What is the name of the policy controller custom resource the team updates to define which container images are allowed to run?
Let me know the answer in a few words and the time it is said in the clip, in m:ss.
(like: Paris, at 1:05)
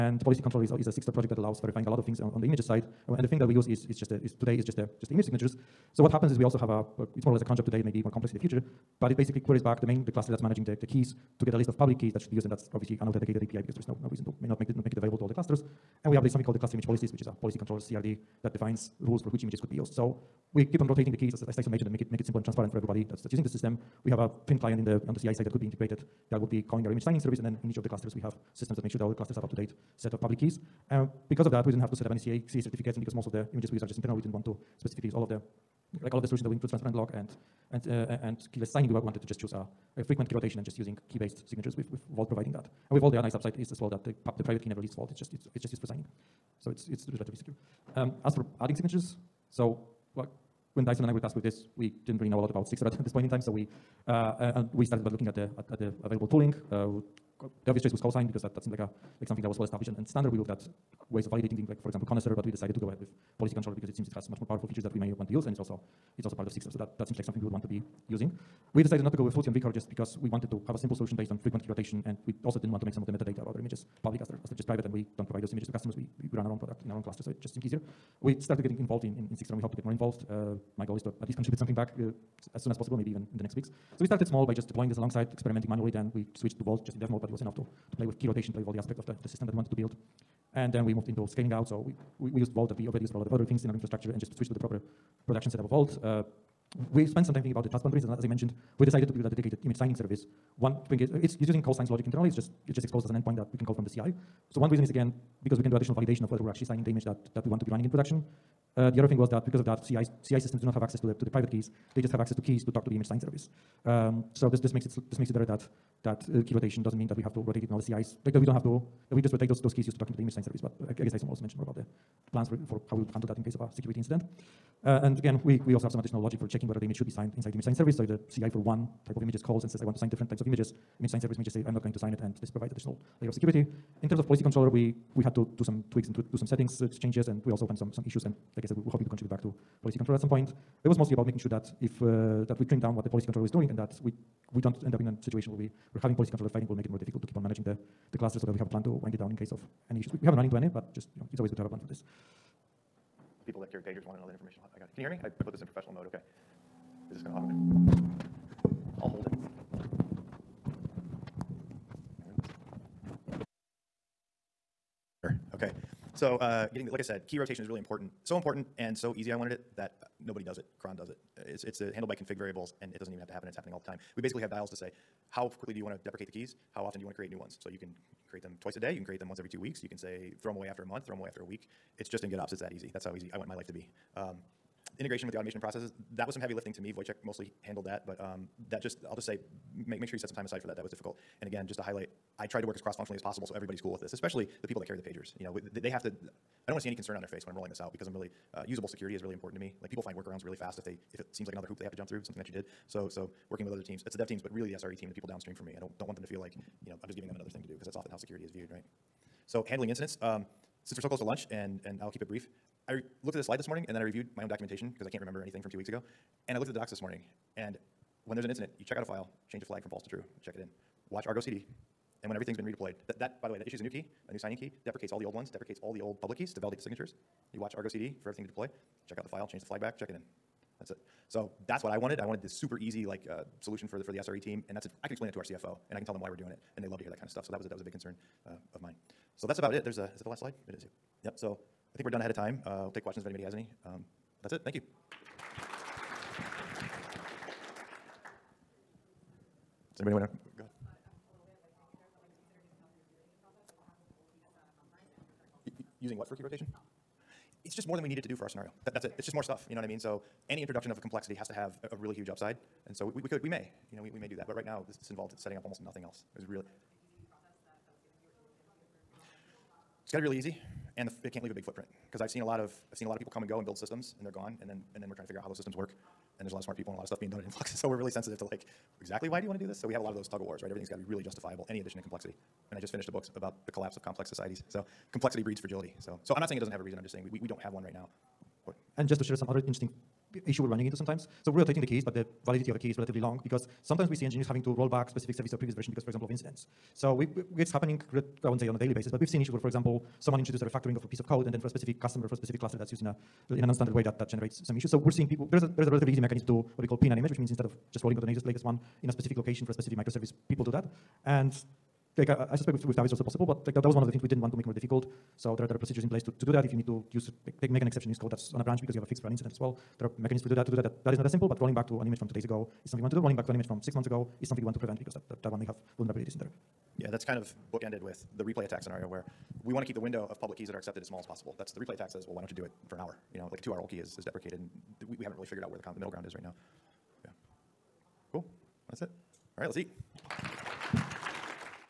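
cluster image policies, at 0:16.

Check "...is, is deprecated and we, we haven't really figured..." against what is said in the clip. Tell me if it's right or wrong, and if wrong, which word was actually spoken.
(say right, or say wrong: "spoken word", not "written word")
right.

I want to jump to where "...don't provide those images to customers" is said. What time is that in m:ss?
1:15.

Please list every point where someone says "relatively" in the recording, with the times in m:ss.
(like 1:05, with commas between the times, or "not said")
0:47, 4:52, 5:05.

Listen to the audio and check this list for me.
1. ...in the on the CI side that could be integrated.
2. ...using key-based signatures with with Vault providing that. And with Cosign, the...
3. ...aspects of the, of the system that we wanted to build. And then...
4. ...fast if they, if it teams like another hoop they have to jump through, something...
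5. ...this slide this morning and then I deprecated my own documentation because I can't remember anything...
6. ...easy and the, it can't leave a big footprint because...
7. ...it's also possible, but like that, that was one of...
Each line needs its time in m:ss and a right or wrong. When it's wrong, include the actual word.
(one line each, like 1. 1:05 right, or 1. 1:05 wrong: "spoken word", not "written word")
1. 0:24 right
2. 0:40 wrong: "Vault", not "Cosign"
3. 1:28 right
4. 3:20 wrong: "seems", not "teams"
5. 3:33 wrong: "reviewed", not "deprecated"
6. 4:30 right
7. 5:13 right.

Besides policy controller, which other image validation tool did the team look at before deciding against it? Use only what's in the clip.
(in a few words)
Connaisseur.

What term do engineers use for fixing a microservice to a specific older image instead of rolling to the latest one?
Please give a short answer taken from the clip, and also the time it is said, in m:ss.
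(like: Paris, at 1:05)
pin an image, at 5:06.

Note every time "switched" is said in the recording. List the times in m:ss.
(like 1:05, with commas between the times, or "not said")
1:26, 1:34.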